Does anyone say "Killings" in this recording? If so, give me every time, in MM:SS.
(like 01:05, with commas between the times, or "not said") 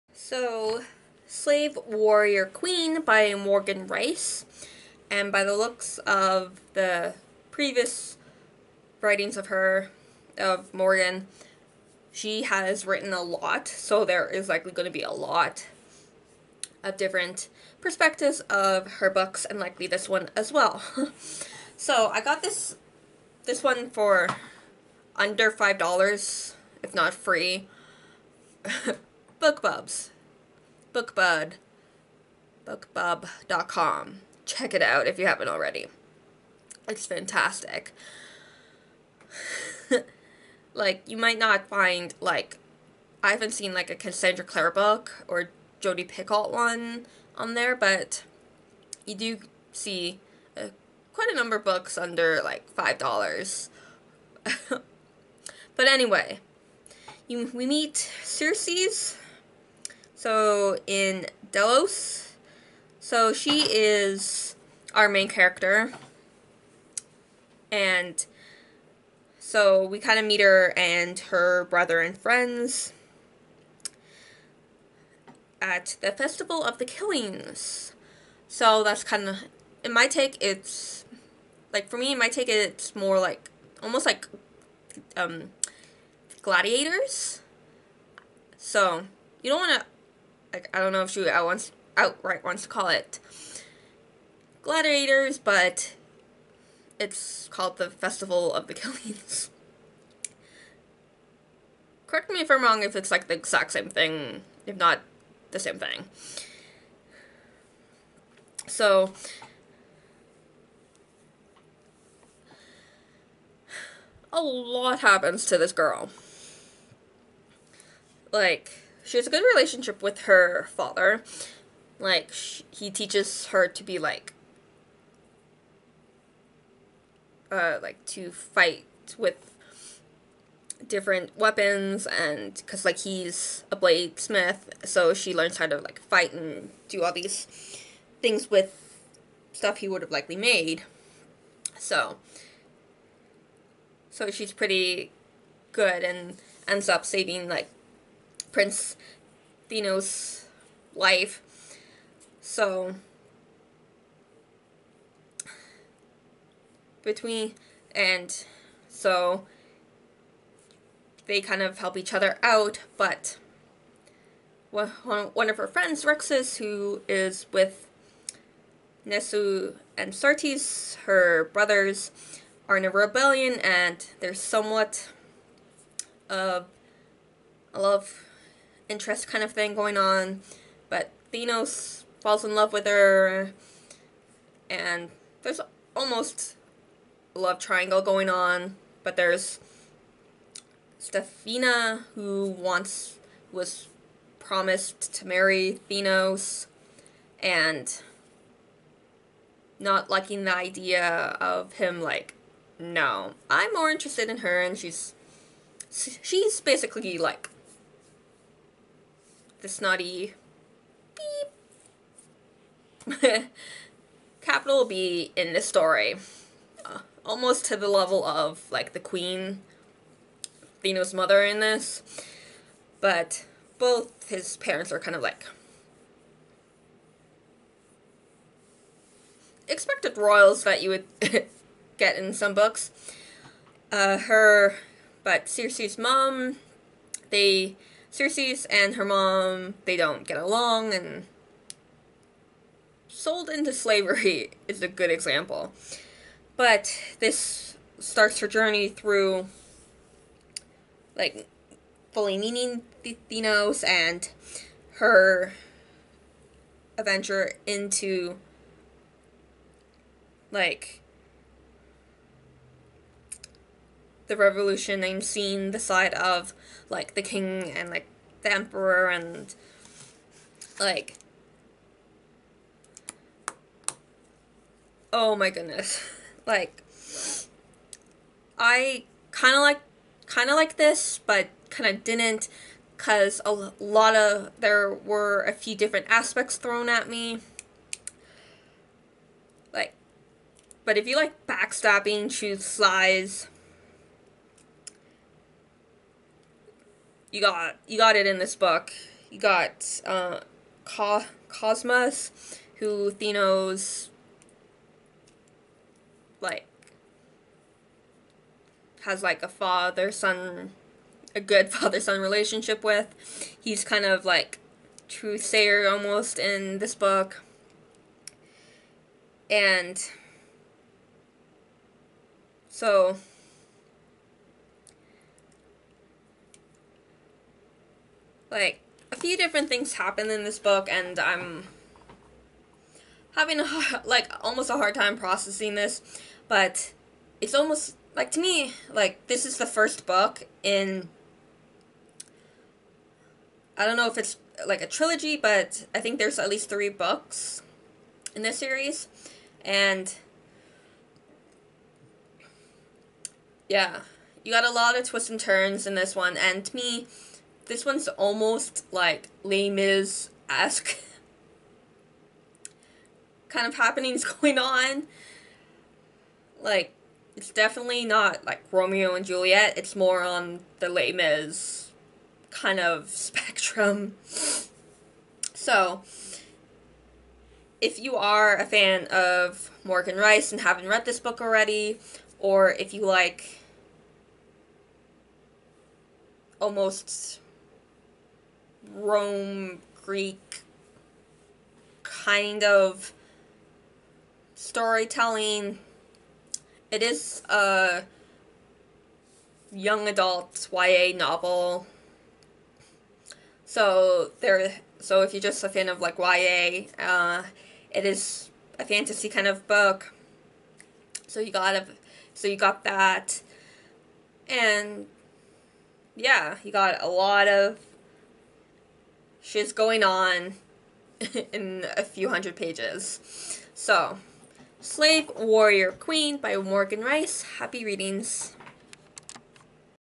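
01:16, 01:38.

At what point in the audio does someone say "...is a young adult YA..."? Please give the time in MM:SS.
06:37.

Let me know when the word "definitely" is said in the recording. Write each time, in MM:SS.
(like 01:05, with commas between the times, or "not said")
06:07.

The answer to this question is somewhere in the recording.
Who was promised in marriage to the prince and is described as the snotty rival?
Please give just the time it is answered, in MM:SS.
03:10.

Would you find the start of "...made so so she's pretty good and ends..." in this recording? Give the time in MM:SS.
02:20.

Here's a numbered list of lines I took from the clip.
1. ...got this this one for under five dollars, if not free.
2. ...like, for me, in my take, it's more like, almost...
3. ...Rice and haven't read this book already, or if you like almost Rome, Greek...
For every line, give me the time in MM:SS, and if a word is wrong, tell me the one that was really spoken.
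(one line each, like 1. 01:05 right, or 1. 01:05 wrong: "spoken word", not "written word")
1. 00:22 right
2. 01:21 right
3. 06:20 right.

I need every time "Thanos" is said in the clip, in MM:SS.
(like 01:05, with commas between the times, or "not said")
02:29, 03:01, 03:15, 03:40, 05:03.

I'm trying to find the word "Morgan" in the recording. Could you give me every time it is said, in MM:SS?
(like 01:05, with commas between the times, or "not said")
00:03, 00:10, 06:19, 07:06.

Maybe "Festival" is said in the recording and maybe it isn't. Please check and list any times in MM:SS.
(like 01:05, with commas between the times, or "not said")
01:16, 01:37.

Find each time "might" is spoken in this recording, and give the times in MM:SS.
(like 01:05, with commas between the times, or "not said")
00:41.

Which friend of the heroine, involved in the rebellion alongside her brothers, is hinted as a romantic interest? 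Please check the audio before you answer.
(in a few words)
Rexus.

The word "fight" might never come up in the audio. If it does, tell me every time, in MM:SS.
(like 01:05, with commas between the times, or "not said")
02:08, 02:16.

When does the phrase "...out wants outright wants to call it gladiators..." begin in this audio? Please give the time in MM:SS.
01:31.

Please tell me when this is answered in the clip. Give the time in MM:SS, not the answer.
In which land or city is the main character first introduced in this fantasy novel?
01:01.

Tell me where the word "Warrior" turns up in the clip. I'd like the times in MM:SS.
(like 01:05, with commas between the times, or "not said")
00:01, 07:05.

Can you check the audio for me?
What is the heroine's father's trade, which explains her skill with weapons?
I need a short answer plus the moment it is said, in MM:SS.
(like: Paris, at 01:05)
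Bladesmith, at 02:13.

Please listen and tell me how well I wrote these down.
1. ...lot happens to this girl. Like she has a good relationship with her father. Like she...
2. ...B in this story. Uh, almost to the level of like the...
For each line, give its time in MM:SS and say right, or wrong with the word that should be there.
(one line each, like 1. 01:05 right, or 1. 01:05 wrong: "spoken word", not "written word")
1. 01:54 right
2. 03:34 right.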